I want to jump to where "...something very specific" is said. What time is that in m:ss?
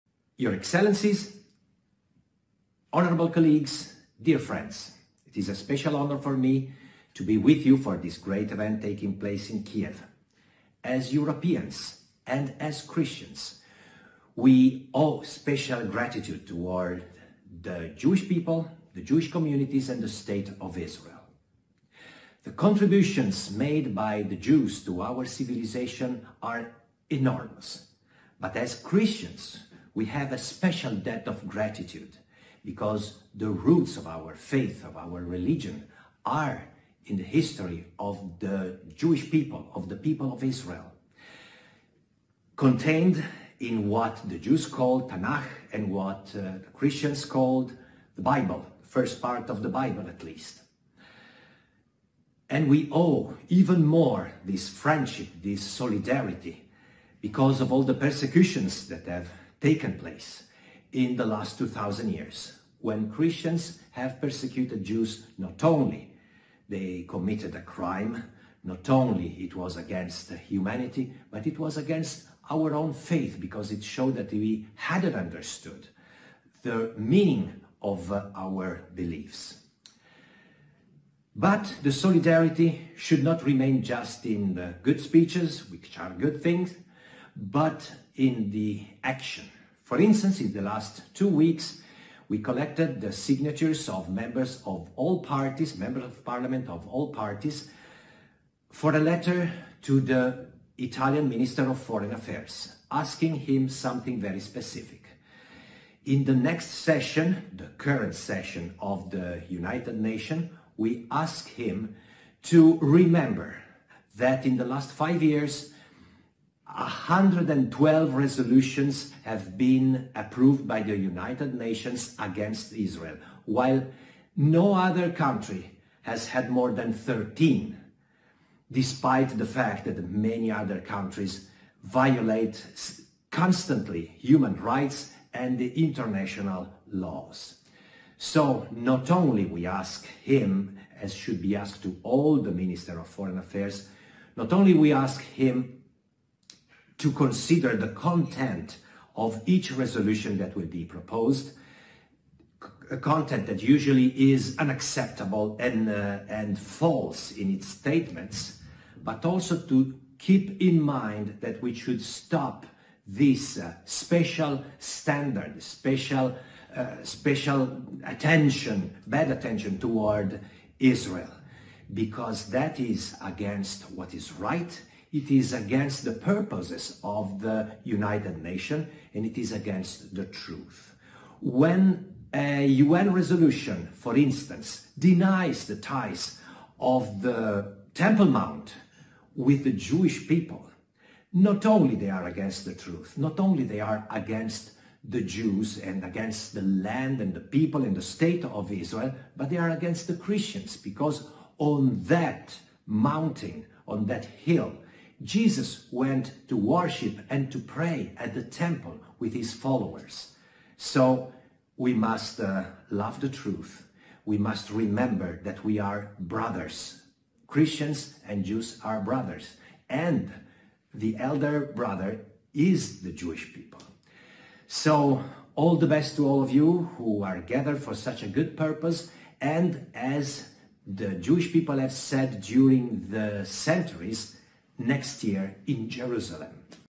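1:43.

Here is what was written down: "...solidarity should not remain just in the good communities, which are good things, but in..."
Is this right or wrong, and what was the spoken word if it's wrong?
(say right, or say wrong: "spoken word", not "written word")
wrong: "speeches", not "communities".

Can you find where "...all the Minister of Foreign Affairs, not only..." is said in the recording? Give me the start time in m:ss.
2:22.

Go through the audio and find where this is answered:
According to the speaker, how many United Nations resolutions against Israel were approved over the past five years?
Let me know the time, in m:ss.
1:56.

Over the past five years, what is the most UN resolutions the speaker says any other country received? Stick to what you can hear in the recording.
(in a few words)
13.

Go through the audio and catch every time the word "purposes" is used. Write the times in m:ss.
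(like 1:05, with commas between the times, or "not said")
2:56, 3:48.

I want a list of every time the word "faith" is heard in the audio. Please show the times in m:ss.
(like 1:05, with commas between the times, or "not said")
0:34, 1:12.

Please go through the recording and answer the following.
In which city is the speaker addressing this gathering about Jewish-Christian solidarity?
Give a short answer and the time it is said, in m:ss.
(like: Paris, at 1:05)
Kiev, at 0:09.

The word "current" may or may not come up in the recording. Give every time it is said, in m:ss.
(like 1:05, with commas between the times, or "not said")
1:47.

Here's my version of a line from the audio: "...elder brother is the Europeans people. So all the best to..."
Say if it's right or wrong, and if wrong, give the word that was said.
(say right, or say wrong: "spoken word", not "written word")
wrong: "Jewish", not "Europeans".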